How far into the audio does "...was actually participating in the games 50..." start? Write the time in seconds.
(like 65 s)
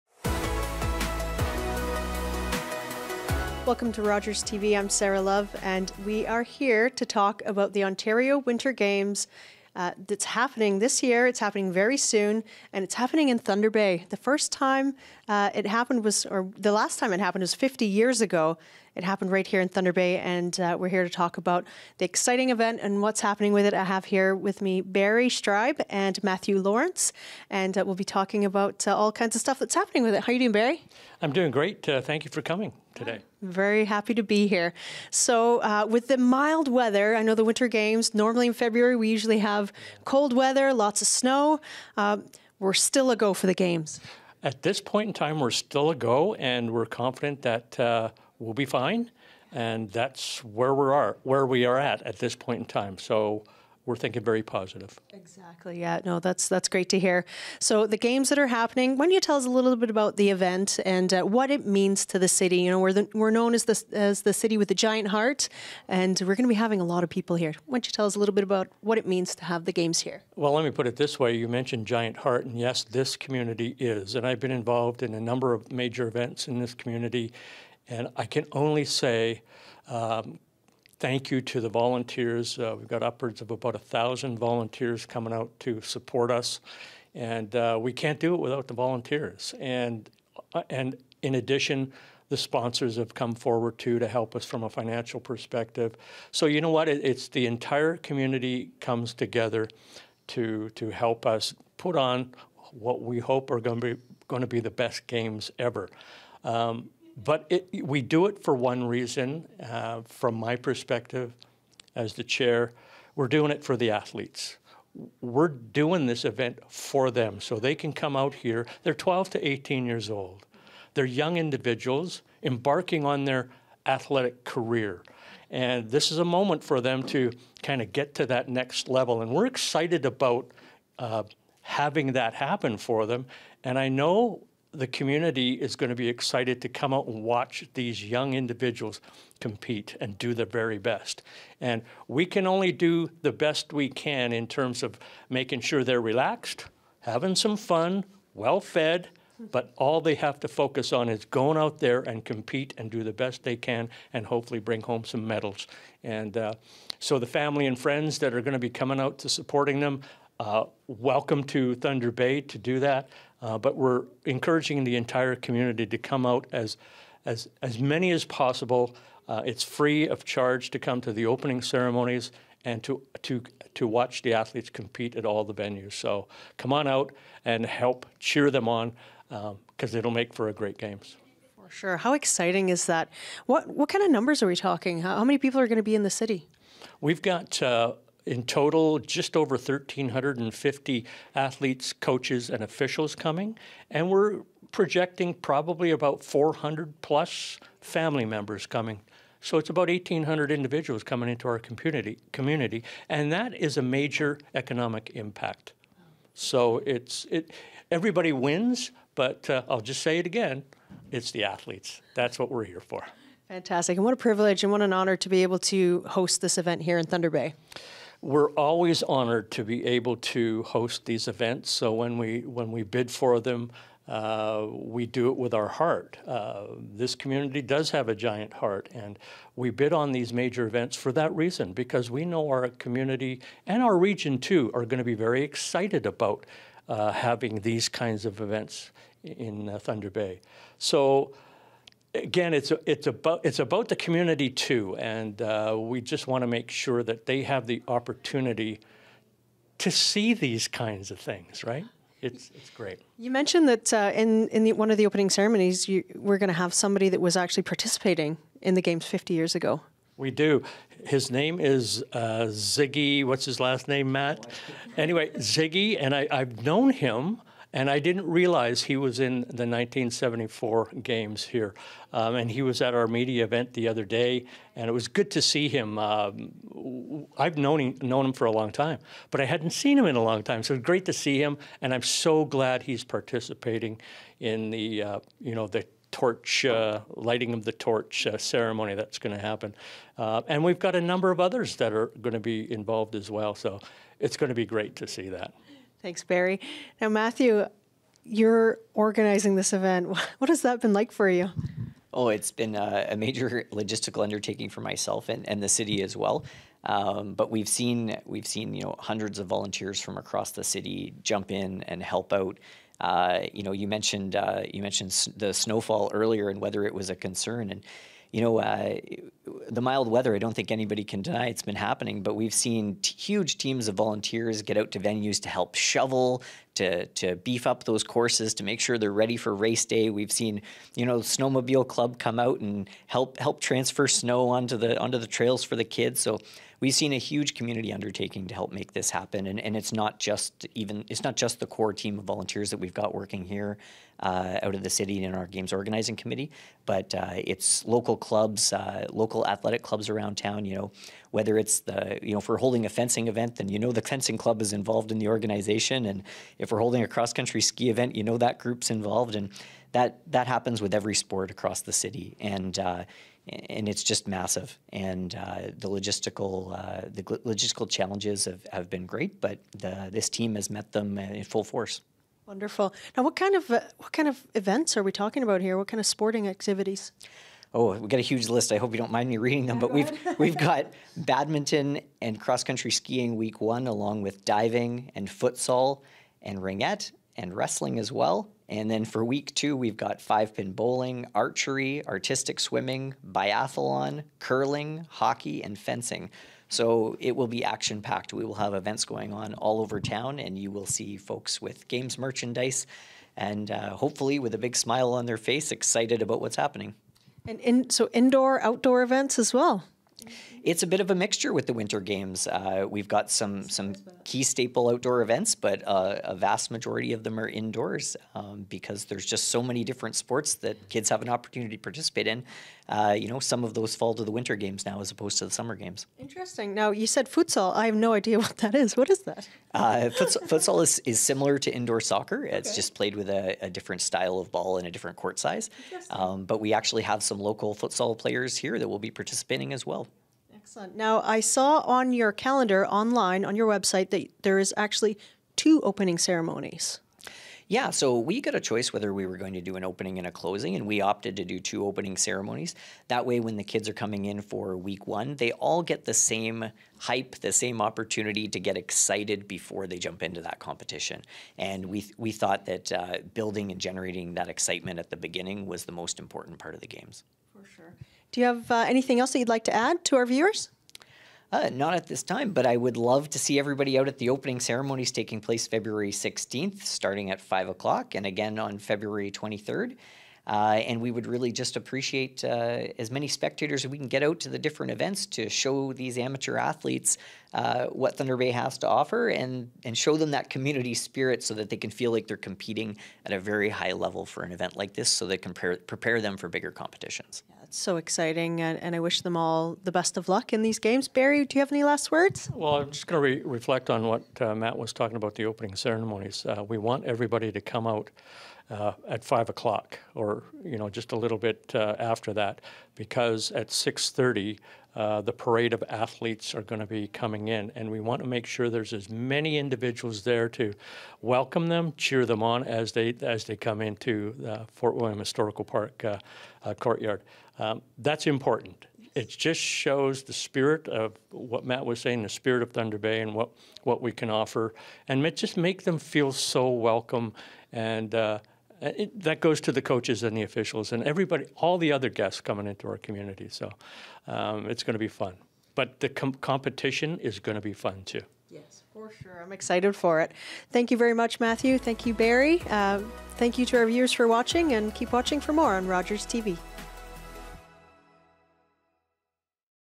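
257 s.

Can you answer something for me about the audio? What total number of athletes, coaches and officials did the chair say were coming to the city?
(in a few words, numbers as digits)
just over 1,350.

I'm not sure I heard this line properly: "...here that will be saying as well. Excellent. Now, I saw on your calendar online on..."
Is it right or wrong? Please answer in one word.
wrong.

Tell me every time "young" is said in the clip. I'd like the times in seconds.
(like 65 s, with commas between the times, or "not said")
121 s, 138 s.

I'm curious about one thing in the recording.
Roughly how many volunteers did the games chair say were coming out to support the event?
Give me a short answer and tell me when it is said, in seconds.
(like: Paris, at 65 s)
about a thousand, at 83 s.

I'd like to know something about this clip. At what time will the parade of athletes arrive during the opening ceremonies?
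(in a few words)
6:30.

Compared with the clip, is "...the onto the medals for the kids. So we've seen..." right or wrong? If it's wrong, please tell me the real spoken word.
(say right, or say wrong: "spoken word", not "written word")
wrong: "trails", not "medals".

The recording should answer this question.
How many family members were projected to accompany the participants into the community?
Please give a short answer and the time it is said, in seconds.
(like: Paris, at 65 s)
400 plus, at 196 s.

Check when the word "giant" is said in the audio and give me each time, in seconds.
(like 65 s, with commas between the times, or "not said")
64 s, 71 s, 228 s.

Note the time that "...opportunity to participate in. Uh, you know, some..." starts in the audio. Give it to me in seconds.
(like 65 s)
421 s.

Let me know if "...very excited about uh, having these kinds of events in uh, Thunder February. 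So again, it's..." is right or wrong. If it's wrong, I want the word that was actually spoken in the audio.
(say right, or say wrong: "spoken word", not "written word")
wrong: "Bay", not "February".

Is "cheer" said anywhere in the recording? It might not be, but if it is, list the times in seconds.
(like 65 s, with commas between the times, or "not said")
178 s, 521 s.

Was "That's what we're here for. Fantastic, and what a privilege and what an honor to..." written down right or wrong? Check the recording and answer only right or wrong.
right.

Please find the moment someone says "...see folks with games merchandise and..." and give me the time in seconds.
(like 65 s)
400 s.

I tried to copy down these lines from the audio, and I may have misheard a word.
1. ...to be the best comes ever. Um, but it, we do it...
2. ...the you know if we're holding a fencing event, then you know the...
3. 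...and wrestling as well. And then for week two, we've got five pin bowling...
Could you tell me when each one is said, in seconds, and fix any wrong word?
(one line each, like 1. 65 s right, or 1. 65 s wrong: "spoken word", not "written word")
1. 104 s wrong: "games", not "comes"
2. 351 s right
3. 387 s right.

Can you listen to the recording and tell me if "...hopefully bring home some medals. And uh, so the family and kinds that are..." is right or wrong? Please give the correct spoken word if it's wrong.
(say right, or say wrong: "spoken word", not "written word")
wrong: "friends", not "kinds".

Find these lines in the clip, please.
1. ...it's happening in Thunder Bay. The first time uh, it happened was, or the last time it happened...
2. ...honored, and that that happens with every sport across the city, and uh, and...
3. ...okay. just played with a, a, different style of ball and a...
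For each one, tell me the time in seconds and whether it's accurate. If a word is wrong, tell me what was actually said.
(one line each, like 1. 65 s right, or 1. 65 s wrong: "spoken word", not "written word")
1. 12 s right
2. 358 s wrong: "involved", not "honored"
3. 432 s right.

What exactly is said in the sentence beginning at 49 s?
And that's where we are, where we are at at this point in time.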